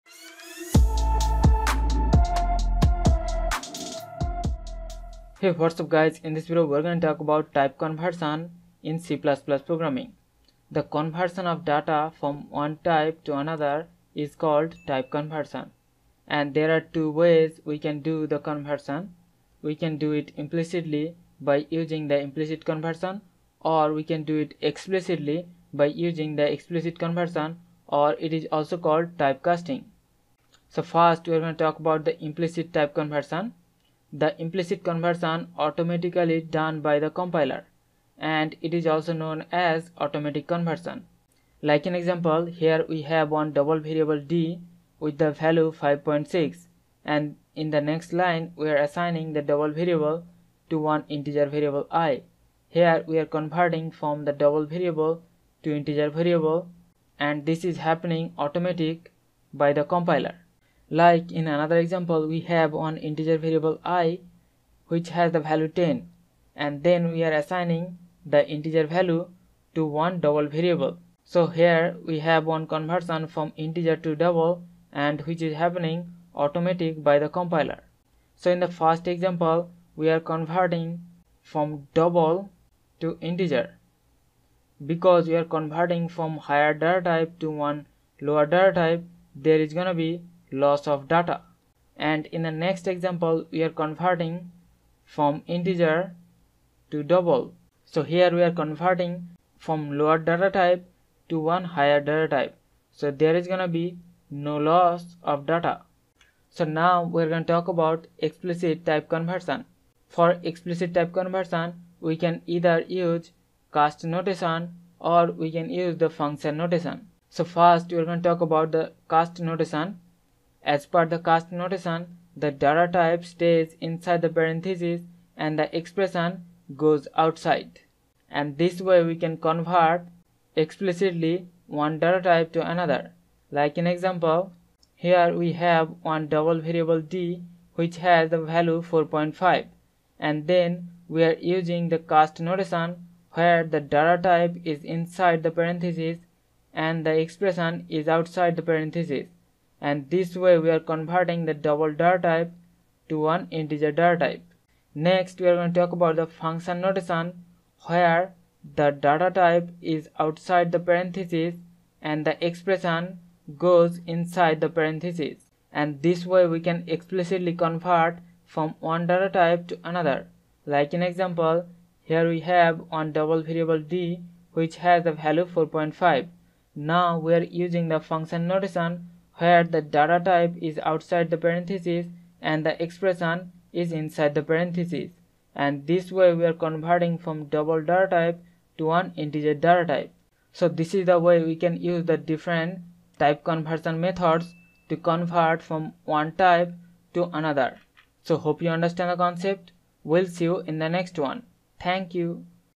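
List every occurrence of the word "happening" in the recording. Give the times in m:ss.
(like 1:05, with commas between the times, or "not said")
0:57, 1:15.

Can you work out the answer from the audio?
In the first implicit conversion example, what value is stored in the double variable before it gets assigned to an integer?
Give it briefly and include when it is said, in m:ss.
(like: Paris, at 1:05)
5.6, at 0:45.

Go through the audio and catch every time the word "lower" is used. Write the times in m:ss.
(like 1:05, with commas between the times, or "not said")
1:28, 1:39.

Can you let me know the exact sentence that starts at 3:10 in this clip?
So this is the way we can use the different type conversion methods to convert from one type to another.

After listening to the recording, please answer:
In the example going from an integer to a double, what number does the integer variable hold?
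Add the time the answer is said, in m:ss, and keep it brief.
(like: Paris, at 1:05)
10, at 1:05.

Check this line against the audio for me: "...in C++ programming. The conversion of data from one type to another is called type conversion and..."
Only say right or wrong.
right.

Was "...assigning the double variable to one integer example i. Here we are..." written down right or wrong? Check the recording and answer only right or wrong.
wrong.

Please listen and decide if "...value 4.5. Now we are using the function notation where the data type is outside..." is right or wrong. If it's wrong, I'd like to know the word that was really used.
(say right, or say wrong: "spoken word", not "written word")
right.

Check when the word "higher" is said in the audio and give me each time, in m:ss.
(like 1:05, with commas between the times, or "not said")
1:26, 1:41.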